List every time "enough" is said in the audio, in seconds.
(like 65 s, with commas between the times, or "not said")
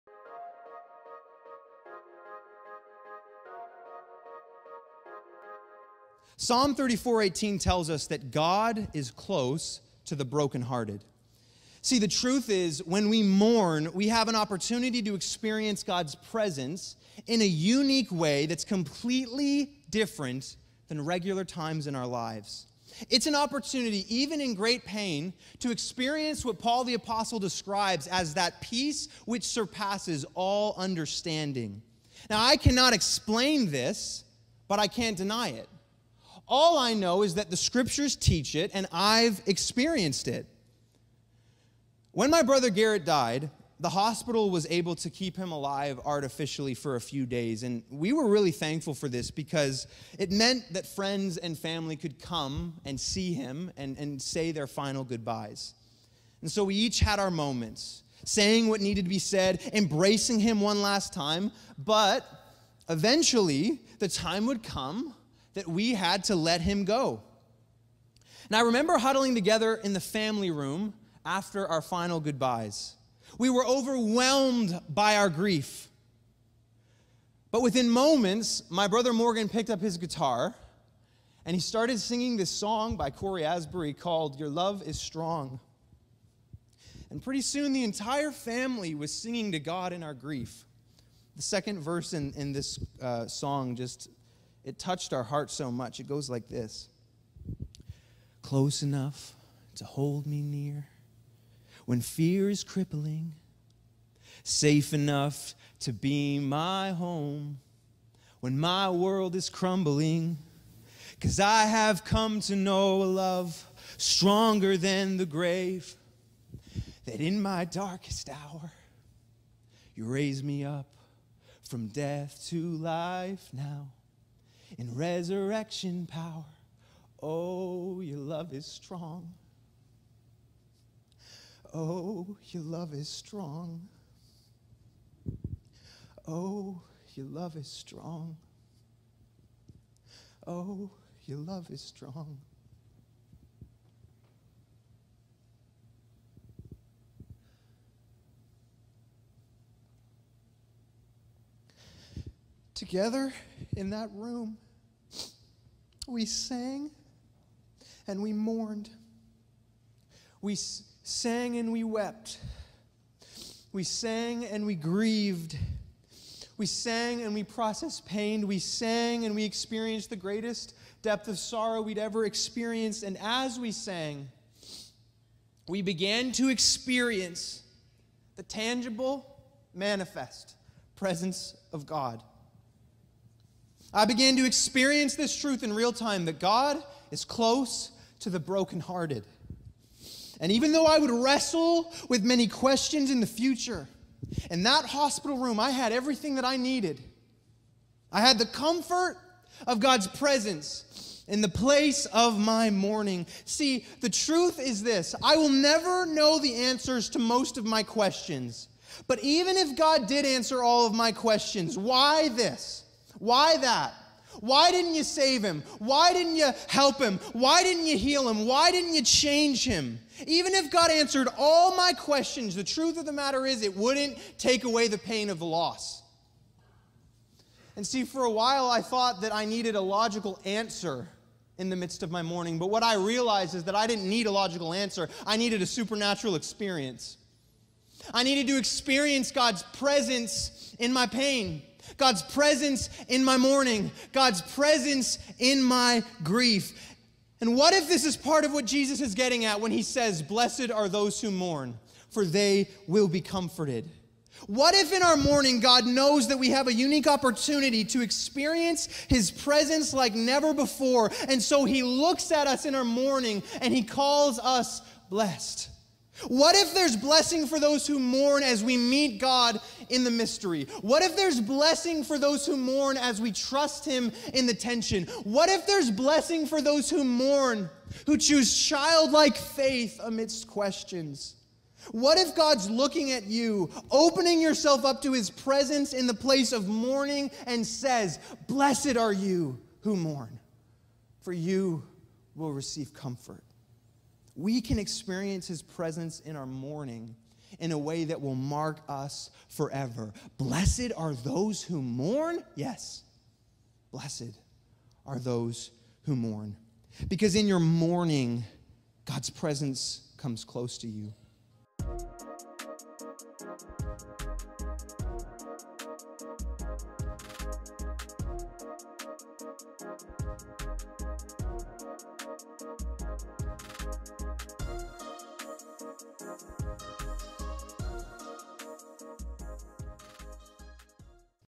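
98 s, 104 s.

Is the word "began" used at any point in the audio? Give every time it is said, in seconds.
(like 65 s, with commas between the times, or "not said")
175 s, 184 s.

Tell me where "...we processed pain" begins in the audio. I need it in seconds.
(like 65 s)
167 s.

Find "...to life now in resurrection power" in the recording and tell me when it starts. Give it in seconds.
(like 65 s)
122 s.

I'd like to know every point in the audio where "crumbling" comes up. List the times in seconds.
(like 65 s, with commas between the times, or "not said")
109 s.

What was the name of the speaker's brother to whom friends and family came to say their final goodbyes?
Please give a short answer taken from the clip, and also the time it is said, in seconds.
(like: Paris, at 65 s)
Garrett, at 42 s.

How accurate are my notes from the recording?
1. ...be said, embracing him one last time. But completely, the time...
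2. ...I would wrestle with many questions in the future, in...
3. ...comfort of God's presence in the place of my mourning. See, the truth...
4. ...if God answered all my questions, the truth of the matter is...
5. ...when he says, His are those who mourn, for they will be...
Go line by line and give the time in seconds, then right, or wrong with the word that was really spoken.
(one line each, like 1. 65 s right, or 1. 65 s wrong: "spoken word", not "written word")
1. 59 s wrong: "eventually", not "completely"
2. 190 s right
3. 198 s right
4. 220 s right
5. 249 s wrong: "Blessed", not "His".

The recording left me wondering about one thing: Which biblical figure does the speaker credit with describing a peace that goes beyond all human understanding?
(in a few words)
Paul the Apostle.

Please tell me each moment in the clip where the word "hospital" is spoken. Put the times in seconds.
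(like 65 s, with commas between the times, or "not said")
43 s, 194 s.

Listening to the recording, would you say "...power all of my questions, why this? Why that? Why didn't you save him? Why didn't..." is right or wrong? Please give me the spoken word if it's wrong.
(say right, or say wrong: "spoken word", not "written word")
wrong: "answer", not "power".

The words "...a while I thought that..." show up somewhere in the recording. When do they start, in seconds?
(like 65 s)
228 s.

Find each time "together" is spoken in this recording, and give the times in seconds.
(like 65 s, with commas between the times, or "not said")
69 s, 152 s.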